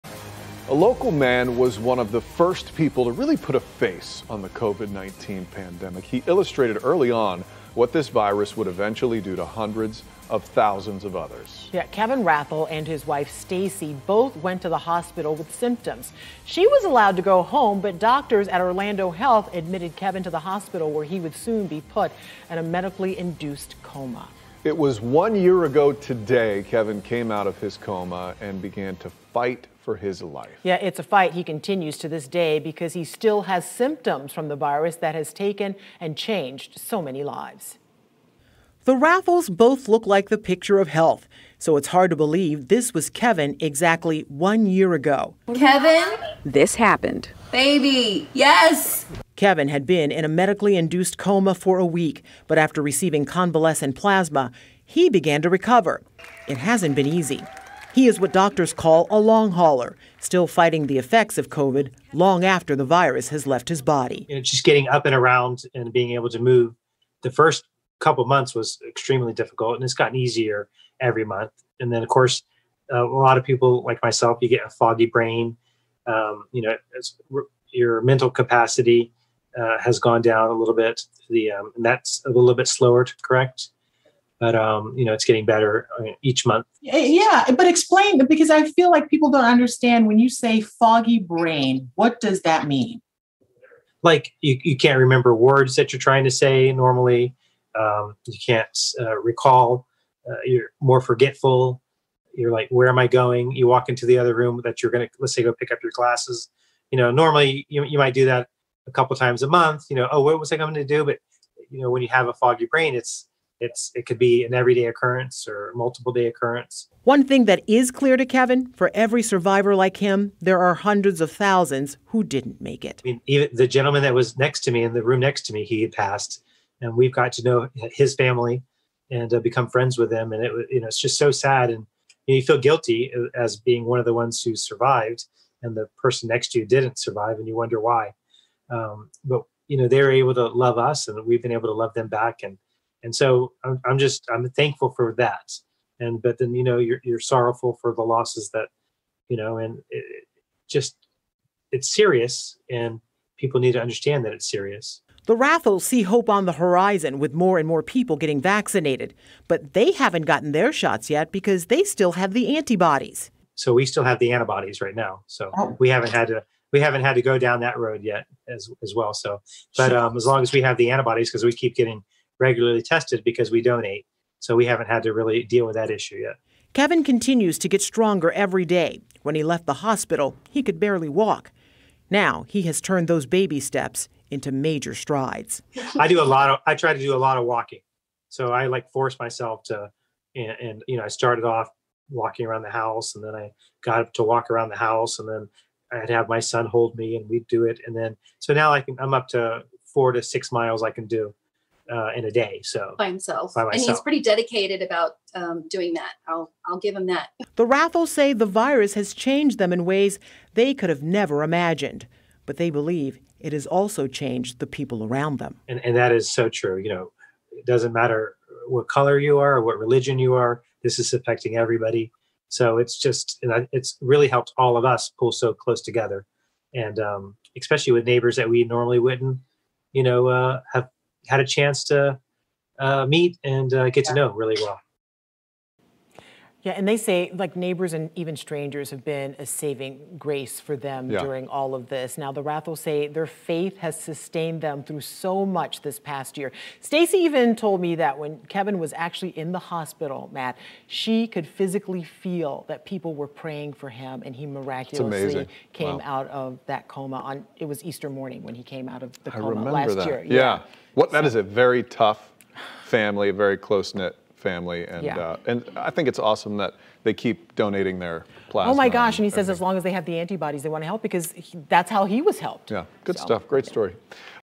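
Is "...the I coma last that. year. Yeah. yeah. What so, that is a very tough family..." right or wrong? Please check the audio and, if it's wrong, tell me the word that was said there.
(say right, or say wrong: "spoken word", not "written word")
right.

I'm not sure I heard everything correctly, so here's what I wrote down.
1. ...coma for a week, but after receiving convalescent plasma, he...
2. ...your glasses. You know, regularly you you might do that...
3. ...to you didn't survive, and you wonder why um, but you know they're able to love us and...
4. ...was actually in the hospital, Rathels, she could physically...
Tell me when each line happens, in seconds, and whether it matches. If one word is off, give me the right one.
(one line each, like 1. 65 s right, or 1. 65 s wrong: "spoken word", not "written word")
1. 51 s right
2. 105 s wrong: "normally", not "regularly"
3. 136 s right
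4. 248 s wrong: "Matt", not "Rathels".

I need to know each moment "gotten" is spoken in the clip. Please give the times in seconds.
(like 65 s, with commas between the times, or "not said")
69 s, 160 s.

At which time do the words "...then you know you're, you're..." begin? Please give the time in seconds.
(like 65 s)
146 s.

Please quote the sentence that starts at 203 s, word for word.
and he's pretty dedicated about um, doing that.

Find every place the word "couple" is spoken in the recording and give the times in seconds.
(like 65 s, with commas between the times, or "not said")
67 s, 108 s.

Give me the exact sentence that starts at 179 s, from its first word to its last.
When he left the hospital, he could barely walk.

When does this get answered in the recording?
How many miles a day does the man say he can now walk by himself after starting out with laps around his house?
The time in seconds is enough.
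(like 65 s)
199 s.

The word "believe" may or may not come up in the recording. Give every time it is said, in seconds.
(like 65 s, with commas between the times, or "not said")
42 s, 212 s.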